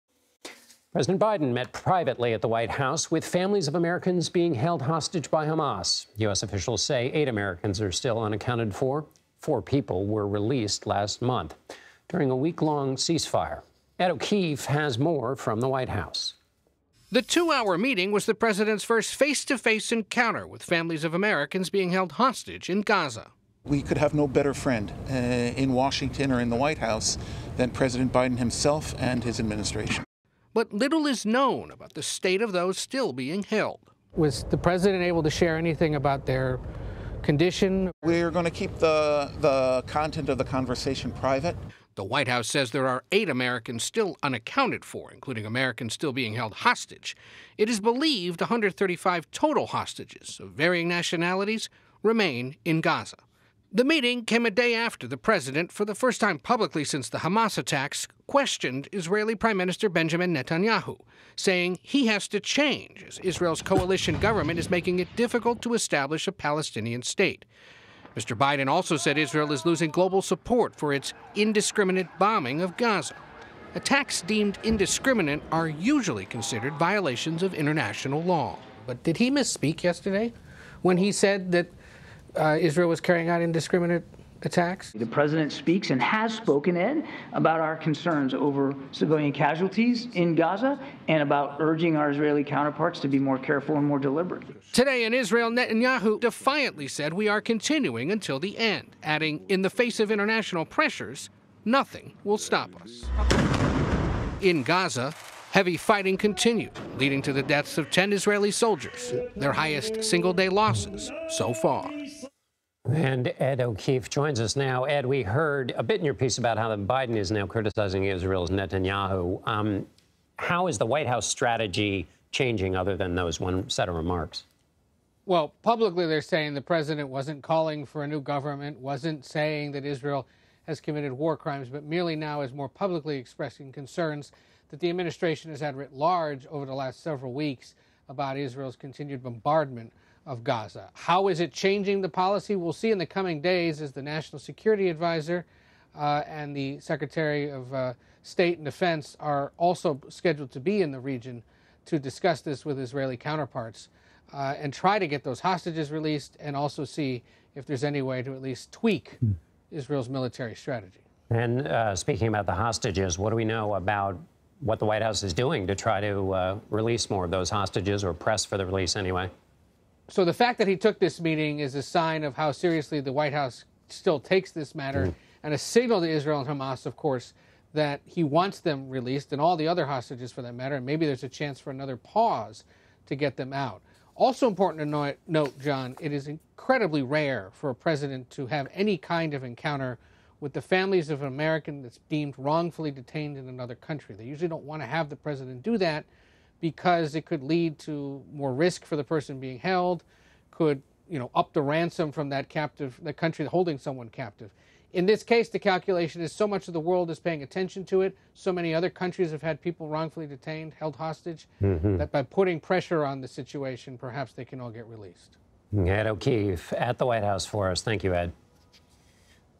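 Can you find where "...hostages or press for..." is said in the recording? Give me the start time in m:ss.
2:47.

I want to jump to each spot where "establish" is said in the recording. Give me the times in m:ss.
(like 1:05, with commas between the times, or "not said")
1:05.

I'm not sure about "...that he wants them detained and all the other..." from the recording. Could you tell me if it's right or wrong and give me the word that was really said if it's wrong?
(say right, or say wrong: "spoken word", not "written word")
wrong: "released", not "detained".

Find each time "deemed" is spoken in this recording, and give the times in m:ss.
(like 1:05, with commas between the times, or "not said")
1:14, 3:12.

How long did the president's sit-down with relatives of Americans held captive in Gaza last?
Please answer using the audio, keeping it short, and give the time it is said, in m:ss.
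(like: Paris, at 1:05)
2 hours, at 0:17.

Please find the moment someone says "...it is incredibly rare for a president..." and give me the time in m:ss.
3:06.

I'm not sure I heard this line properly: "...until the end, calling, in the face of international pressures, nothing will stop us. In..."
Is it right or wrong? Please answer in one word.
wrong.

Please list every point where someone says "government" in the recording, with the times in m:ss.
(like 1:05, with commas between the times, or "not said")
1:04, 2:08.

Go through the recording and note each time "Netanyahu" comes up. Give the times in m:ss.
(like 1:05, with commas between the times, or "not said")
1:00, 1:35, 1:58.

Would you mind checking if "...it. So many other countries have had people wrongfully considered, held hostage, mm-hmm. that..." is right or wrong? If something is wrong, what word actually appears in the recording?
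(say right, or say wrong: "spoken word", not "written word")
wrong: "detained", not "considered".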